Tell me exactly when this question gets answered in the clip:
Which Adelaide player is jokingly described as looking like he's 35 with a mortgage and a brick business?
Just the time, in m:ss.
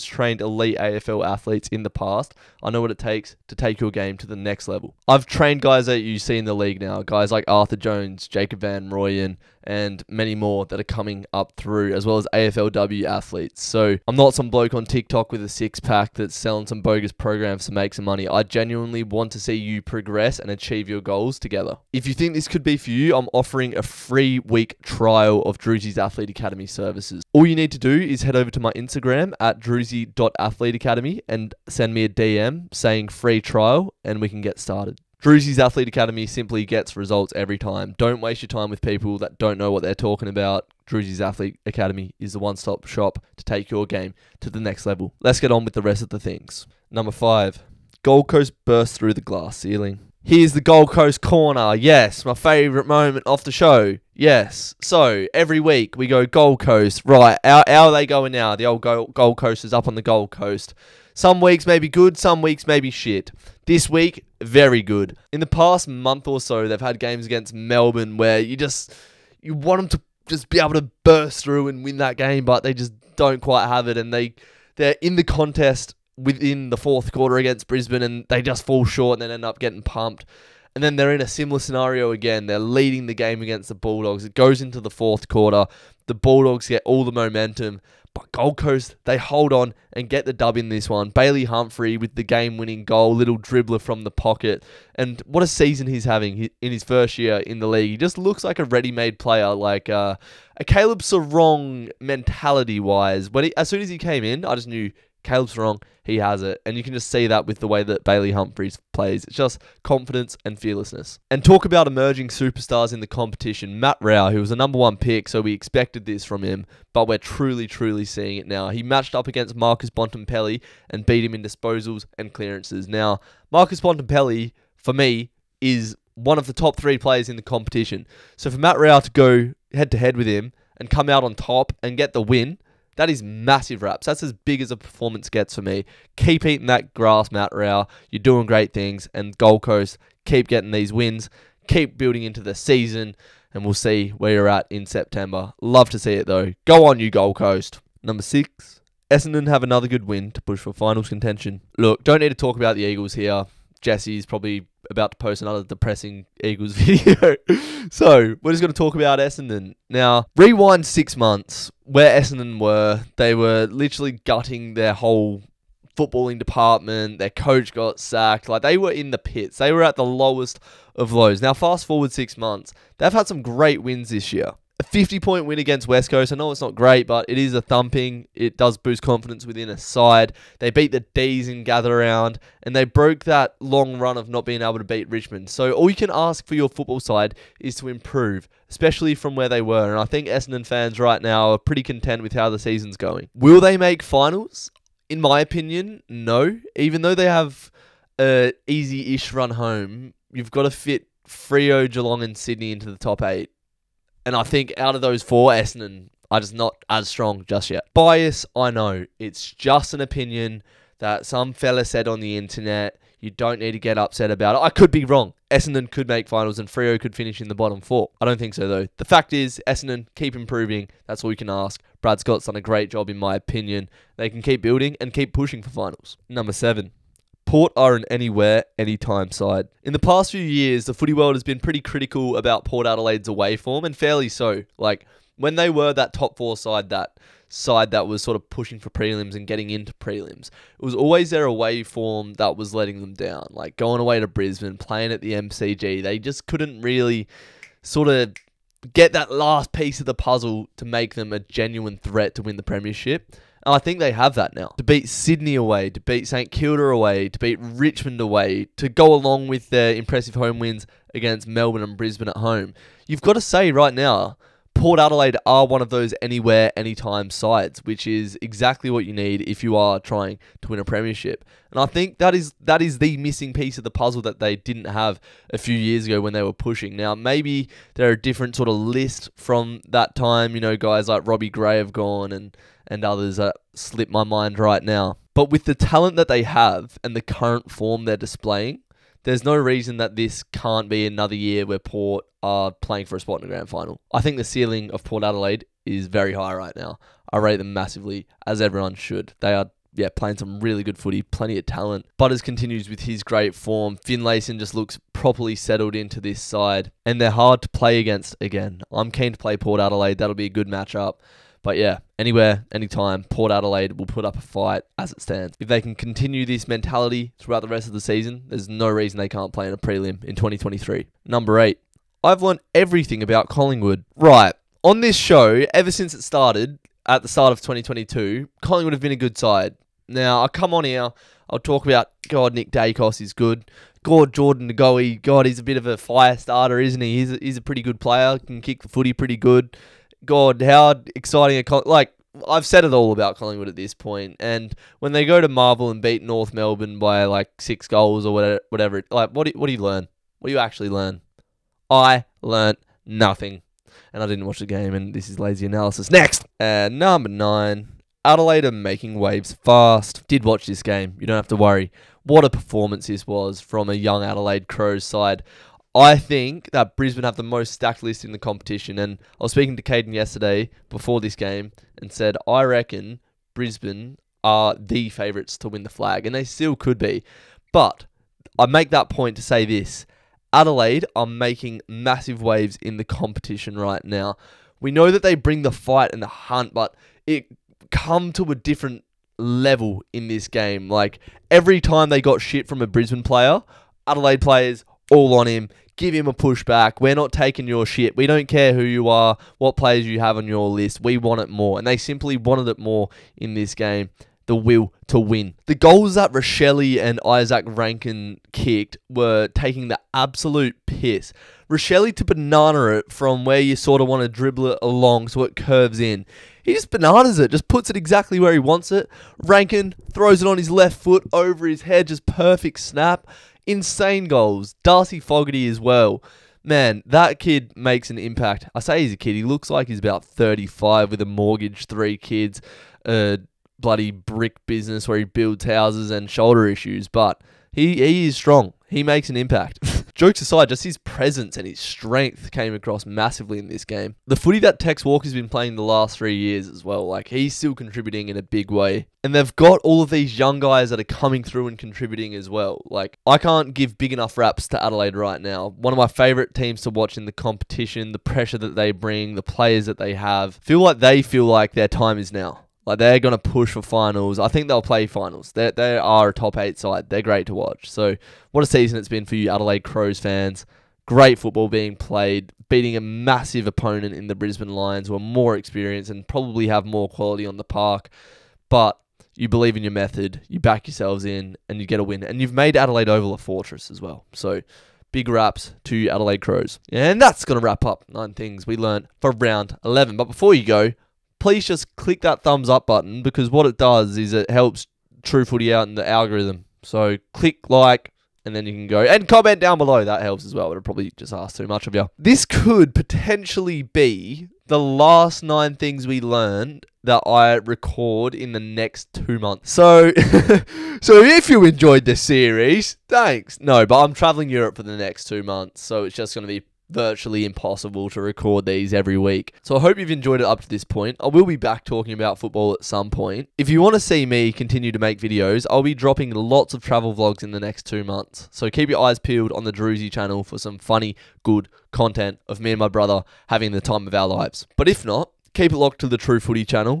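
7:04.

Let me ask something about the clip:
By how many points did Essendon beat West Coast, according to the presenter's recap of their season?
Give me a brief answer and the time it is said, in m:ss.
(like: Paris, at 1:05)
50, at 2:54.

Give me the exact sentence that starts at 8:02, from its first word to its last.
And you've made Adelaide Oval a fortress as well.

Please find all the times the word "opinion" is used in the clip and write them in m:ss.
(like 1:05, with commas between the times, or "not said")
3:15, 3:29, 3:43.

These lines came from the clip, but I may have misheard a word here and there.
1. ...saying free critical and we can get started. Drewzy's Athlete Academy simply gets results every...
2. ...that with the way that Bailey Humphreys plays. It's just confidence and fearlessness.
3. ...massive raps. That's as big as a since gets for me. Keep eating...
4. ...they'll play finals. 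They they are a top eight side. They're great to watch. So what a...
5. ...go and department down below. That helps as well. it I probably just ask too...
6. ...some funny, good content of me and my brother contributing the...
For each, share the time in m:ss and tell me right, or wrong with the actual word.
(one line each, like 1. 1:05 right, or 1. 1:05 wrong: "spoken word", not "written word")
1. 0:32 wrong: "trial", not "critical"
2. 1:47 right
3. 2:13 wrong: "performance", not "since"
4. 7:44 right
5. 8:18 wrong: "comment", not "department"
6. 8:50 wrong: "having", not "contributing".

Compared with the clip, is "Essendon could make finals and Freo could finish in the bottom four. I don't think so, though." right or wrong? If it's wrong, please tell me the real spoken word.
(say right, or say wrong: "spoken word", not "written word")
right.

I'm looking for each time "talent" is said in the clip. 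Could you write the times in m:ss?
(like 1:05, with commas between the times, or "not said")
4:45, 5:01.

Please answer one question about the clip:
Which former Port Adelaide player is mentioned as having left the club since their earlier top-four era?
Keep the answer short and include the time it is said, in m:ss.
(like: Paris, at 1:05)
Robbie Gray, at 4:41.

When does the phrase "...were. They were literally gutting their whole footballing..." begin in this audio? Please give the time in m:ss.
2:42.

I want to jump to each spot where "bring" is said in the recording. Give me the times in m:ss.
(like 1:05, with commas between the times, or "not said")
6:25, 7:38.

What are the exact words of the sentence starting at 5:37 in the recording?
He's a, he's a pretty good player, can kick the footy pretty good.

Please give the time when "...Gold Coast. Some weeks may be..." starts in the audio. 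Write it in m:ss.
1:00.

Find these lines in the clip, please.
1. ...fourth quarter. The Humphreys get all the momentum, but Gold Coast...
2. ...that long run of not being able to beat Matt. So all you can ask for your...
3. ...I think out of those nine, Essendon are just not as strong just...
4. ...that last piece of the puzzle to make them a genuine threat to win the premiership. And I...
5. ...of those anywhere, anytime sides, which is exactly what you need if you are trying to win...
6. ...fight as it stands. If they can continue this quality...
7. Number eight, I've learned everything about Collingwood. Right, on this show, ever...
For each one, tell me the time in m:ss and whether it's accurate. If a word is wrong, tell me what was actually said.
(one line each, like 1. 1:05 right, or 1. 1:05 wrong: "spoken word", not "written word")
1. 1:24 wrong: "Bulldogs", not "Humphreys"
2. 3:03 wrong: "Richmond", not "Matt"
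3. 3:24 wrong: "four", not "nine"
4. 4:09 right
5. 4:25 right
6. 5:14 wrong: "mentality", not "quality"
7. 5:21 right.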